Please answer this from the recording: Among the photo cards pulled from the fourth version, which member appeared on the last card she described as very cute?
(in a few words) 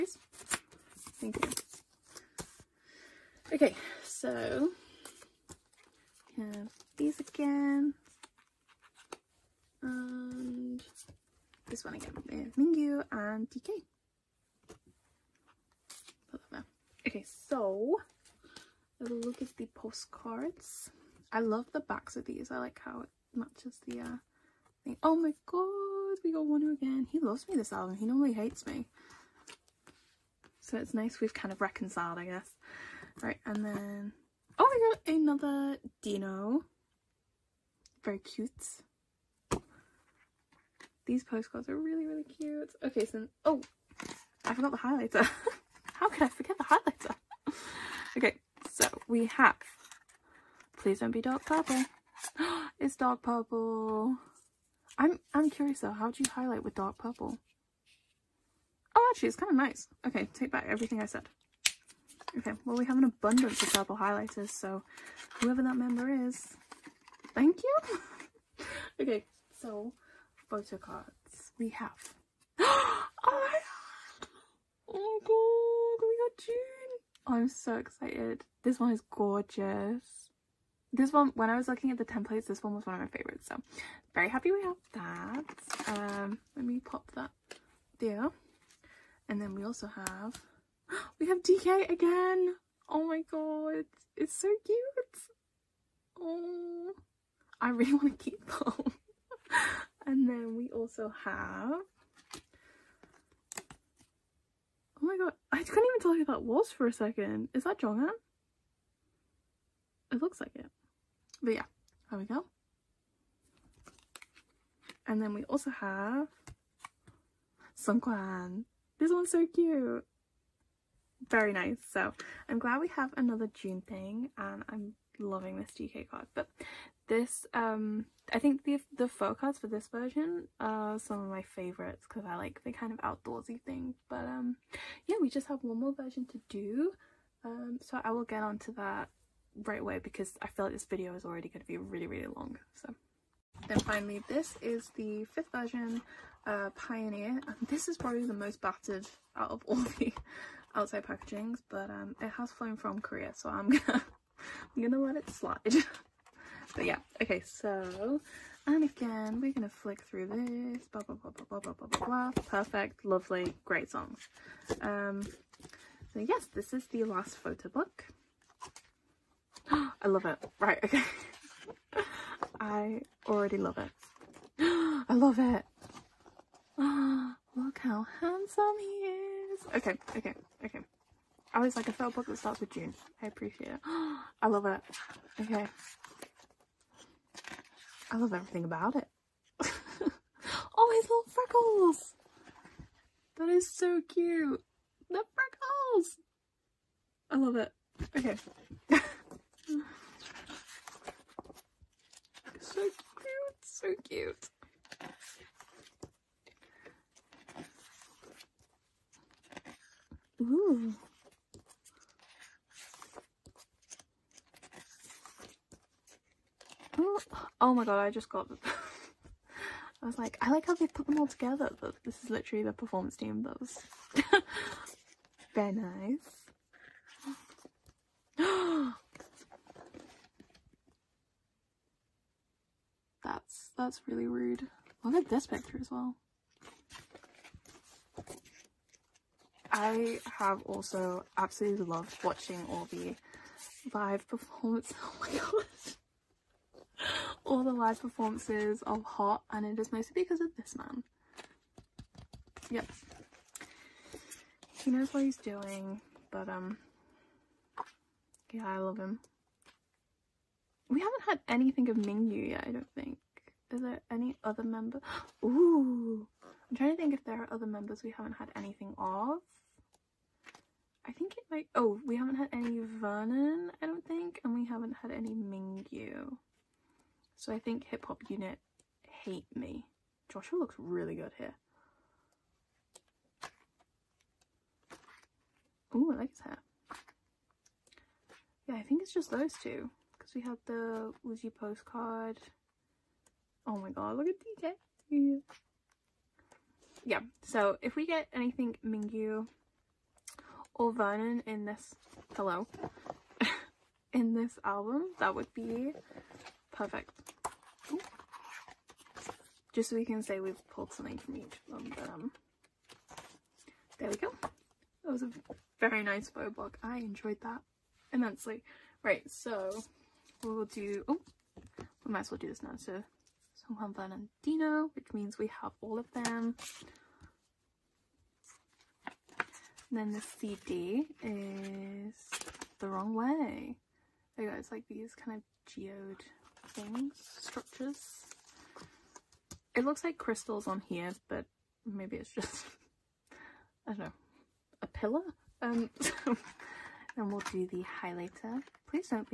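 Seungkwan.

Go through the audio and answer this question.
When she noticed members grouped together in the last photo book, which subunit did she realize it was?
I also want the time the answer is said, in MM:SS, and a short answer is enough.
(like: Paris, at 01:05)
the performance team, at 03:42.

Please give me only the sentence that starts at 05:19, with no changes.
Right, so we'll do, oh, we might as well do this now.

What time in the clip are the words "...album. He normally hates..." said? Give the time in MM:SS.
00:27.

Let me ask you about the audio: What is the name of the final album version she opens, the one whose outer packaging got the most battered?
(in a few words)
Pioneer.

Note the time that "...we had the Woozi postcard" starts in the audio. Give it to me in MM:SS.
04:50.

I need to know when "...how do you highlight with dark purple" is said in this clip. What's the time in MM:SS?
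00:55.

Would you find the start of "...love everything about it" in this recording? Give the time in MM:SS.
03:08.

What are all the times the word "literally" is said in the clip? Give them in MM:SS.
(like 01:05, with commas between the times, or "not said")
03:42.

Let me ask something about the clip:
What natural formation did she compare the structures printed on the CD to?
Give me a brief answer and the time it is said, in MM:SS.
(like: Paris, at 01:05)
geode, at 05:35.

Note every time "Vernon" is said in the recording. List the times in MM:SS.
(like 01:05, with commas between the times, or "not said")
04:32, 05:00.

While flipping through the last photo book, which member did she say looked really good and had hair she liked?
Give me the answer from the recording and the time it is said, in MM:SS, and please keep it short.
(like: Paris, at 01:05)
Joshua, at 04:40.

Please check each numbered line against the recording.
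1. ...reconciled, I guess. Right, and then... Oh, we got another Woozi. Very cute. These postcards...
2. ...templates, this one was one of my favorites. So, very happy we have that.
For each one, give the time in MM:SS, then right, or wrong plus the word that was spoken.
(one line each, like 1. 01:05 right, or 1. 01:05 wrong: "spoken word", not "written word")
1. 00:31 wrong: "Dino", not "Woozi"
2. 01:22 right.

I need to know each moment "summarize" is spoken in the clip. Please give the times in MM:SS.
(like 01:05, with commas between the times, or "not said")
not said.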